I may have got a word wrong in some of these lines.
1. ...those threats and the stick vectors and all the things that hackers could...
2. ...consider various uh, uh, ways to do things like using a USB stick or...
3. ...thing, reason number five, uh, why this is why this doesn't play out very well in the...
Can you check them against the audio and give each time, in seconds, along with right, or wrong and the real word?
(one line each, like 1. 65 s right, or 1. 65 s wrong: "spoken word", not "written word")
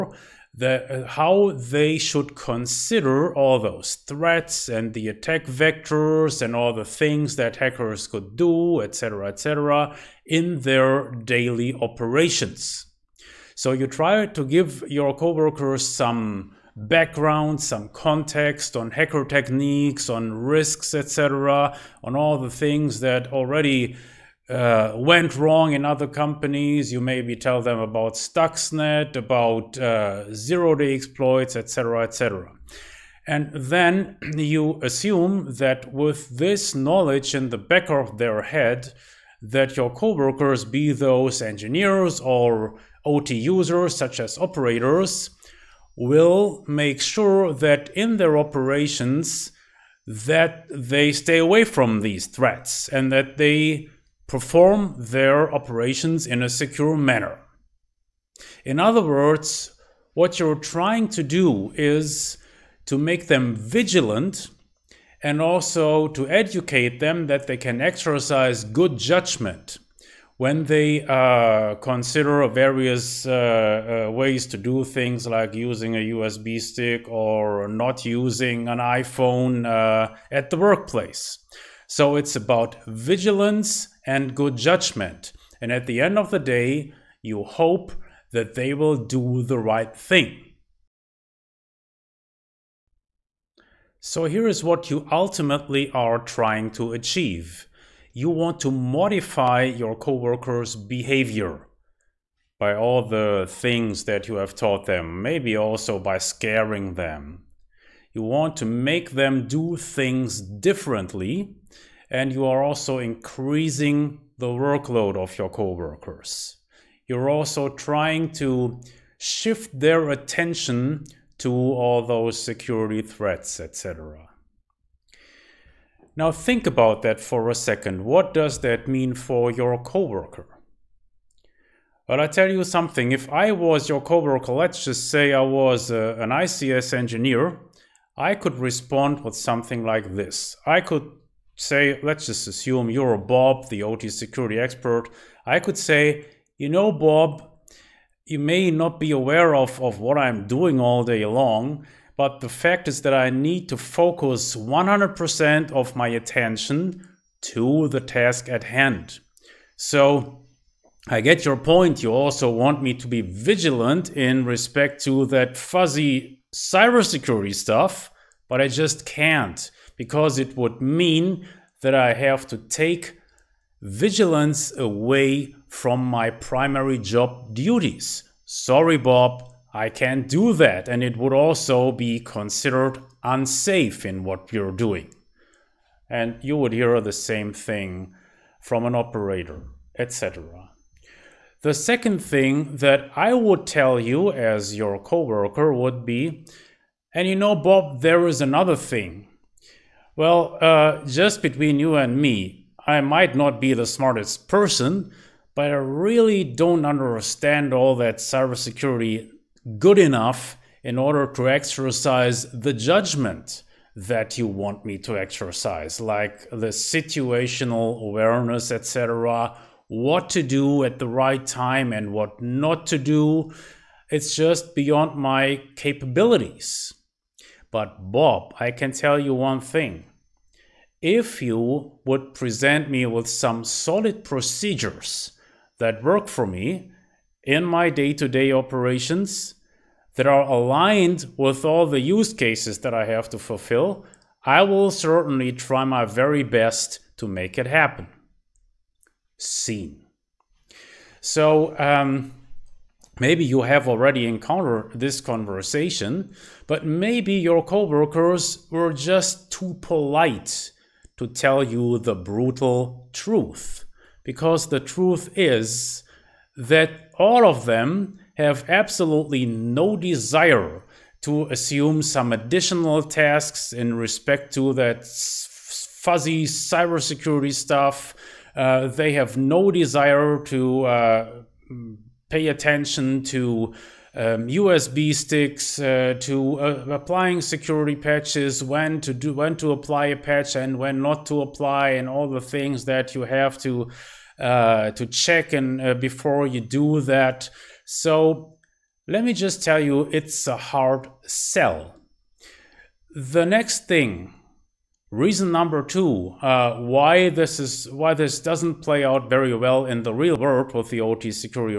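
1. 3 s wrong: "attack", not "stick"
2. 71 s right
3. 303 s wrong: "two", not "five".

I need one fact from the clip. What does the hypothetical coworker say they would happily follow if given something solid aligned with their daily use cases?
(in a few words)
procedures.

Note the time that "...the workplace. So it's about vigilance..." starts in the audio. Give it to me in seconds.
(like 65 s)
80 s.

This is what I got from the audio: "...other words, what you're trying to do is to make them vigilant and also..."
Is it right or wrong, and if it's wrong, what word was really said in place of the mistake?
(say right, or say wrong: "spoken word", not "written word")
right.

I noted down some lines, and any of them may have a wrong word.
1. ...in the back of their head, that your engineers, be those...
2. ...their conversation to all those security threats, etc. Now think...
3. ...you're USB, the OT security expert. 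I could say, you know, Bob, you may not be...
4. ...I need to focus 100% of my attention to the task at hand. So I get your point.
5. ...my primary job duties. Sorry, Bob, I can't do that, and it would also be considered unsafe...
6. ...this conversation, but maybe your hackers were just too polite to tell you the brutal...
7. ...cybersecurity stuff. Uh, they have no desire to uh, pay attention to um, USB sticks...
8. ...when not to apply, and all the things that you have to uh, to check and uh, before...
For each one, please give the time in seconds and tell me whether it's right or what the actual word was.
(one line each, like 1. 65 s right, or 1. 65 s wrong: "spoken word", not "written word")
1. 37 s wrong: "coworkers", not "engineers"
2. 119 s wrong: "attention", not "conversation"
3. 142 s wrong: "Bob", not "USB"
4. 153 s right
5. 176 s right
6. 254 s wrong: "coworkers", not "hackers"
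7. 276 s right
8. 290 s right.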